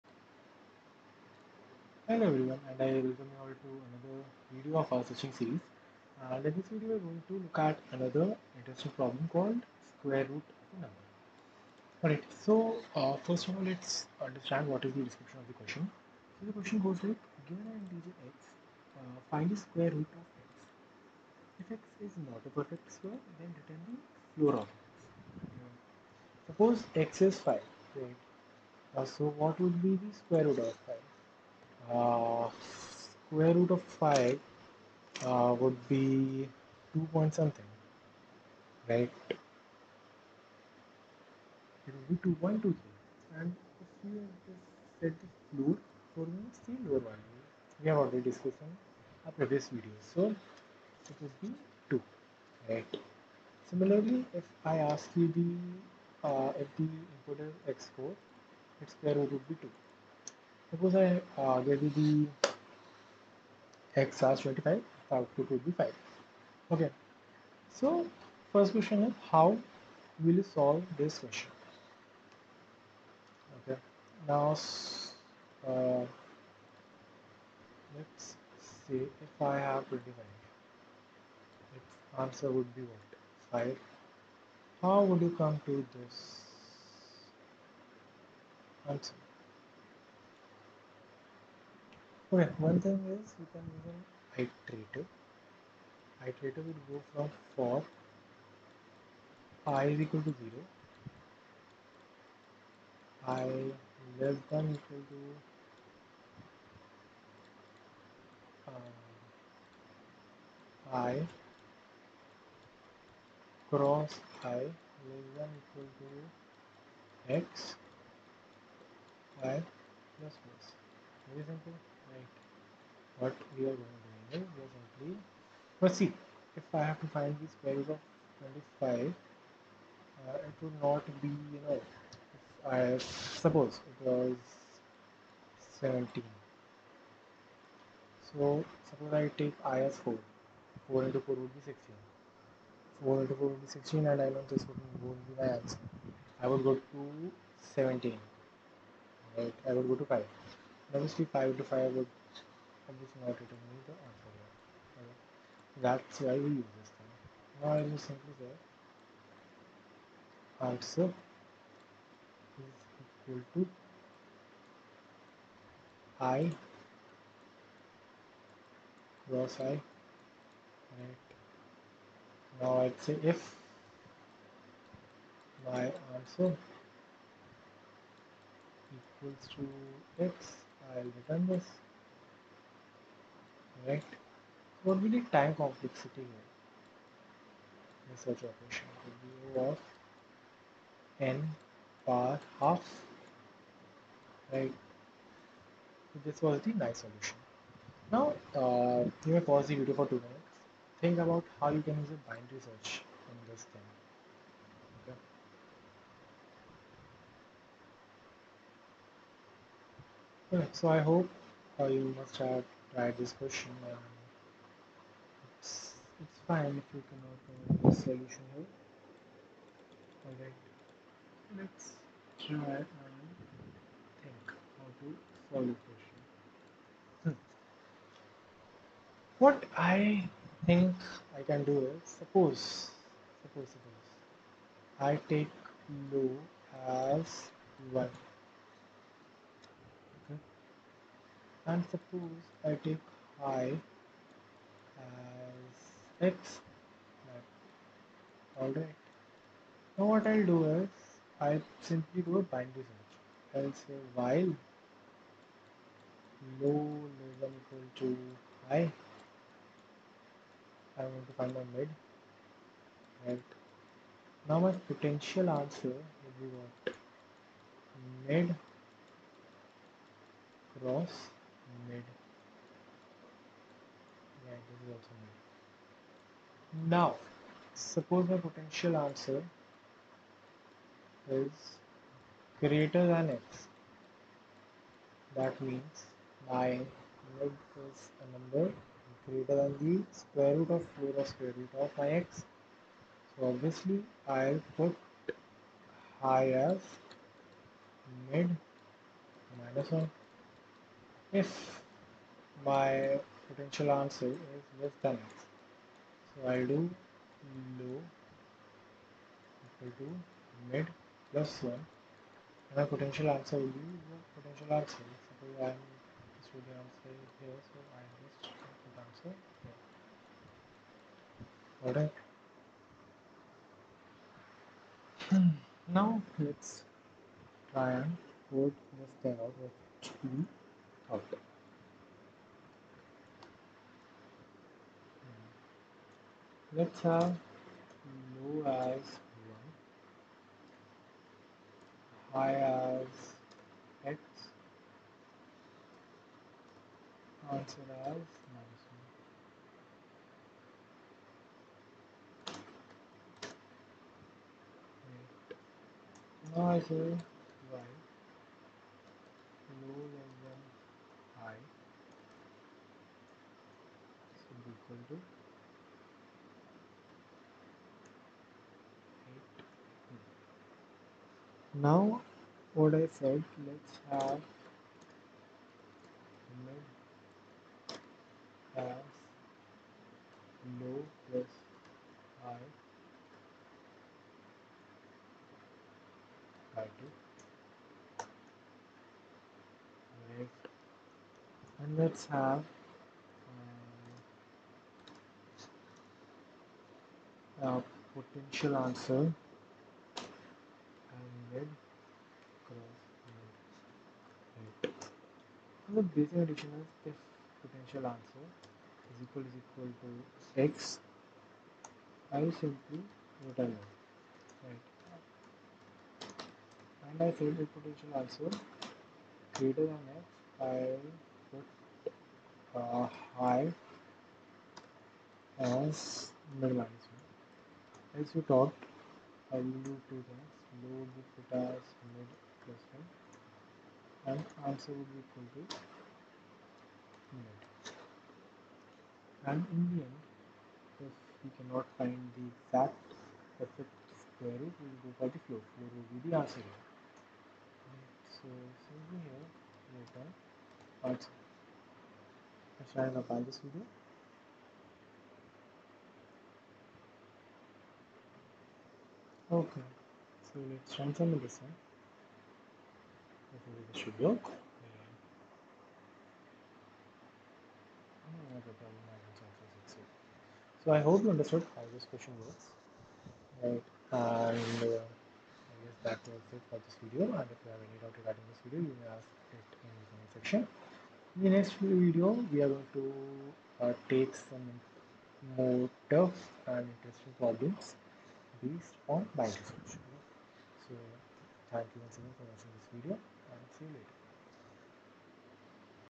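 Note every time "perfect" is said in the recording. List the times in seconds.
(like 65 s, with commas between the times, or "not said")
22 s, 443 s.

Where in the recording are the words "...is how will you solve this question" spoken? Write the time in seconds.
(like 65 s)
69 s.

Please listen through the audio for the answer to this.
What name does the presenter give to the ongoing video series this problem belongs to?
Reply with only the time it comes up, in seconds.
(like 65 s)
5 s.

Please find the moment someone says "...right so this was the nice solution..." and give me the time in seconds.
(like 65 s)
194 s.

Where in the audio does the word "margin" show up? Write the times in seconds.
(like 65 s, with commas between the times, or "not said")
not said.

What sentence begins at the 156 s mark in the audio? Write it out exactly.
That's why we use this thing.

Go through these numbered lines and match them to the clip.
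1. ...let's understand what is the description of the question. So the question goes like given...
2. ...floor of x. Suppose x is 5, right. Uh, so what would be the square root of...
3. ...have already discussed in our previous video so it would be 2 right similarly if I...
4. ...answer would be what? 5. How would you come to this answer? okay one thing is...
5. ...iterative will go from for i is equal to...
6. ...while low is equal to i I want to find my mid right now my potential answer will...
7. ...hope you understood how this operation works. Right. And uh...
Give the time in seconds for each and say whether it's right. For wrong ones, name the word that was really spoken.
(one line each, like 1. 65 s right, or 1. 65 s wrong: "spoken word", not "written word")
1. 13 s right
2. 24 s right
3. 47 s right
4. 82 s right
5. 96 s right
6. 254 s right
7. 470 s wrong: "question", not "operation".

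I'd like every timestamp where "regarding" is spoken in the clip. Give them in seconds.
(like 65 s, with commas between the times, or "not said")
478 s.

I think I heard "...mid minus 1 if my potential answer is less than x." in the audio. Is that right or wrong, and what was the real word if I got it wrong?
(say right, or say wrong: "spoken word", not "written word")
right.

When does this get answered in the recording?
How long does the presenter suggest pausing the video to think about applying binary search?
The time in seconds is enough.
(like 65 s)
200 s.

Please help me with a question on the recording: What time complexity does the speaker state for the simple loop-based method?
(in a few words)
O of n power half.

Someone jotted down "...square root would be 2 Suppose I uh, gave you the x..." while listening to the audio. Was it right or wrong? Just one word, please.
right.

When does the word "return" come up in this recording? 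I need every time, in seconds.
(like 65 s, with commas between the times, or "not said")
23 s, 153 s, 181 s, 413 s.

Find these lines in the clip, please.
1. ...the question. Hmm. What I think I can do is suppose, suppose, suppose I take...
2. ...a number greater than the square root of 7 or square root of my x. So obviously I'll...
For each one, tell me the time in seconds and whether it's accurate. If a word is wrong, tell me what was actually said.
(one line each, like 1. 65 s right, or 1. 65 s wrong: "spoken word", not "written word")
1. 225 s right
2. 288 s wrong: "4", not "7".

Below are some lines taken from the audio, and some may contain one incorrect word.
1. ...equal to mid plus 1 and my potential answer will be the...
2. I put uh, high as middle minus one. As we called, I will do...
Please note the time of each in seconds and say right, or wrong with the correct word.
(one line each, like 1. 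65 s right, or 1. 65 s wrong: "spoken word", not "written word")
1. 309 s right
2. 420 s wrong: "talked", not "called".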